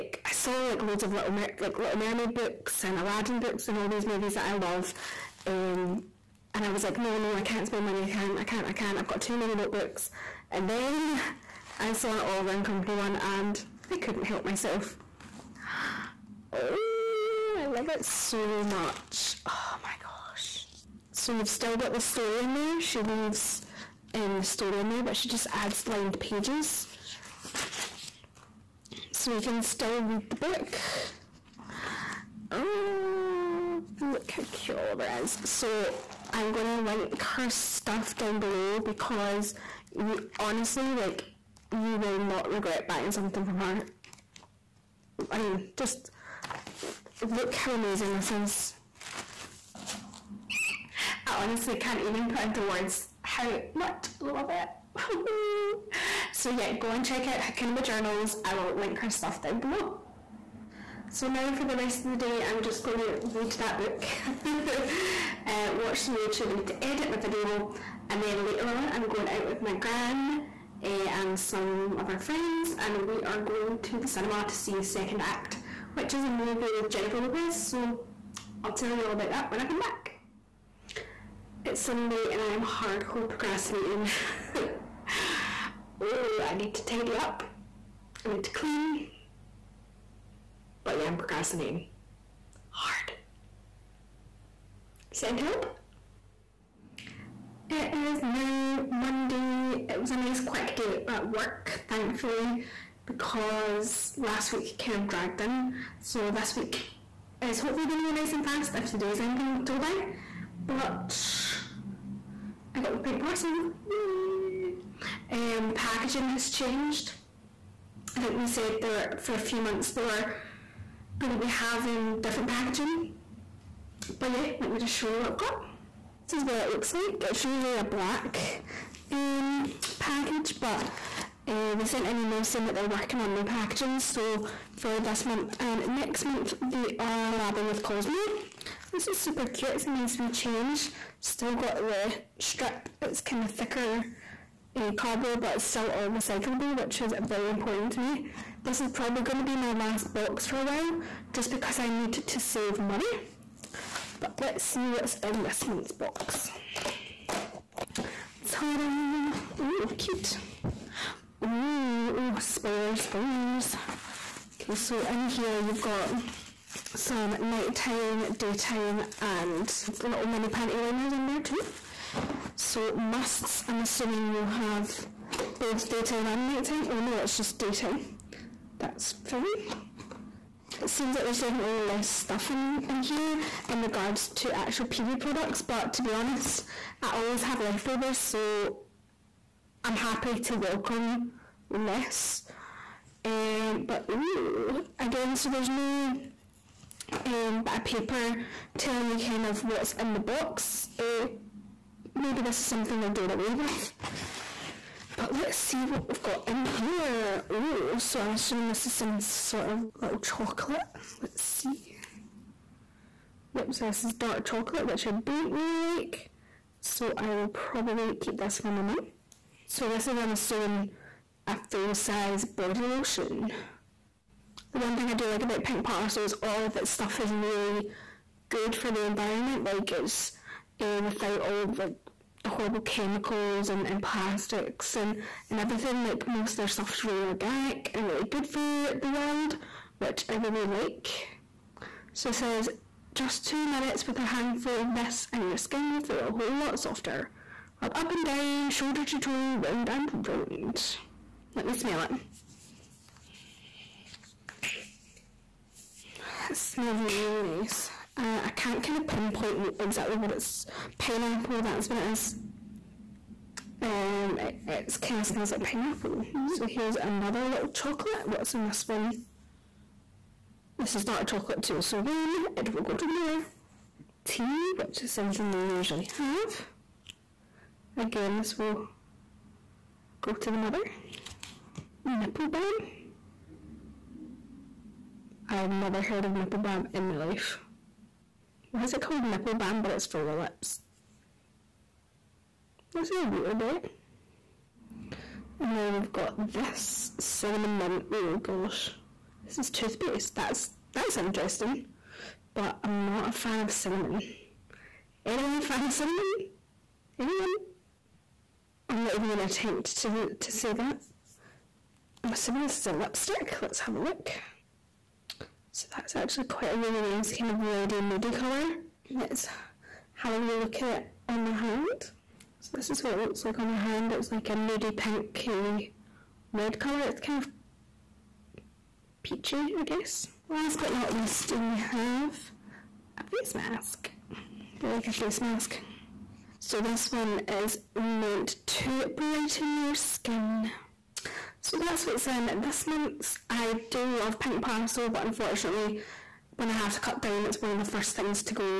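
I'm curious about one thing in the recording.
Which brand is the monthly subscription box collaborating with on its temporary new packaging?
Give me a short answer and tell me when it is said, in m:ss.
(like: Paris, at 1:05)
Cosmo, at 2:17.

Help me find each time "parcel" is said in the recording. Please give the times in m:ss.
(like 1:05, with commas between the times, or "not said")
1:53, 3:45, 5:44.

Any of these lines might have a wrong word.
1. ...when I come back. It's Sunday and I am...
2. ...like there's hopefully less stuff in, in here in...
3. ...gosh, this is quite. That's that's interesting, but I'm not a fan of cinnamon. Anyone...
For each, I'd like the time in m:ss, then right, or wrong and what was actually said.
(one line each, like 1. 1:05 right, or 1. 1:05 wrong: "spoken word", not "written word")
1. 1:19 right
2. 3:01 wrong: "definitely", not "hopefully"
3. 4:58 wrong: "toothpaste", not "quite".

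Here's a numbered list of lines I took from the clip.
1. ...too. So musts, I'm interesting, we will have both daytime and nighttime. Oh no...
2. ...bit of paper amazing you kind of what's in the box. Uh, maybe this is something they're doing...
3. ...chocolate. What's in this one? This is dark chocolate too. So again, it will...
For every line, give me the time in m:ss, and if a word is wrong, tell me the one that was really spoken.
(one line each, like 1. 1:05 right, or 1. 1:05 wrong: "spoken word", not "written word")
1. 2:51 wrong: "assuming", not "interesting"
2. 3:17 wrong: "telling", not "amazing"
3. 4:27 right.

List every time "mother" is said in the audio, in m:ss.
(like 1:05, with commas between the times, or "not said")
4:33, 4:40.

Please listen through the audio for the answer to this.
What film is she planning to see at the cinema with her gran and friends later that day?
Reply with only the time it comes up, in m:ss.
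1:14.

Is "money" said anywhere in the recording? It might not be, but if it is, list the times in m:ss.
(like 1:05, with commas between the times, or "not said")
0:07, 2:32.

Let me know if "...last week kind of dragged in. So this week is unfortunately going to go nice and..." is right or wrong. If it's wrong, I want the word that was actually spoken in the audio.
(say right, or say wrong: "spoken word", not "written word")
wrong: "hopefully", not "unfortunately".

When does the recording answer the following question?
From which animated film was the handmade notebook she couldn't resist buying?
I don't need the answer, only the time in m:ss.
0:12.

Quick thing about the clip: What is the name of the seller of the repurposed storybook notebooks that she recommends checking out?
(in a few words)
Hakuna Majournals.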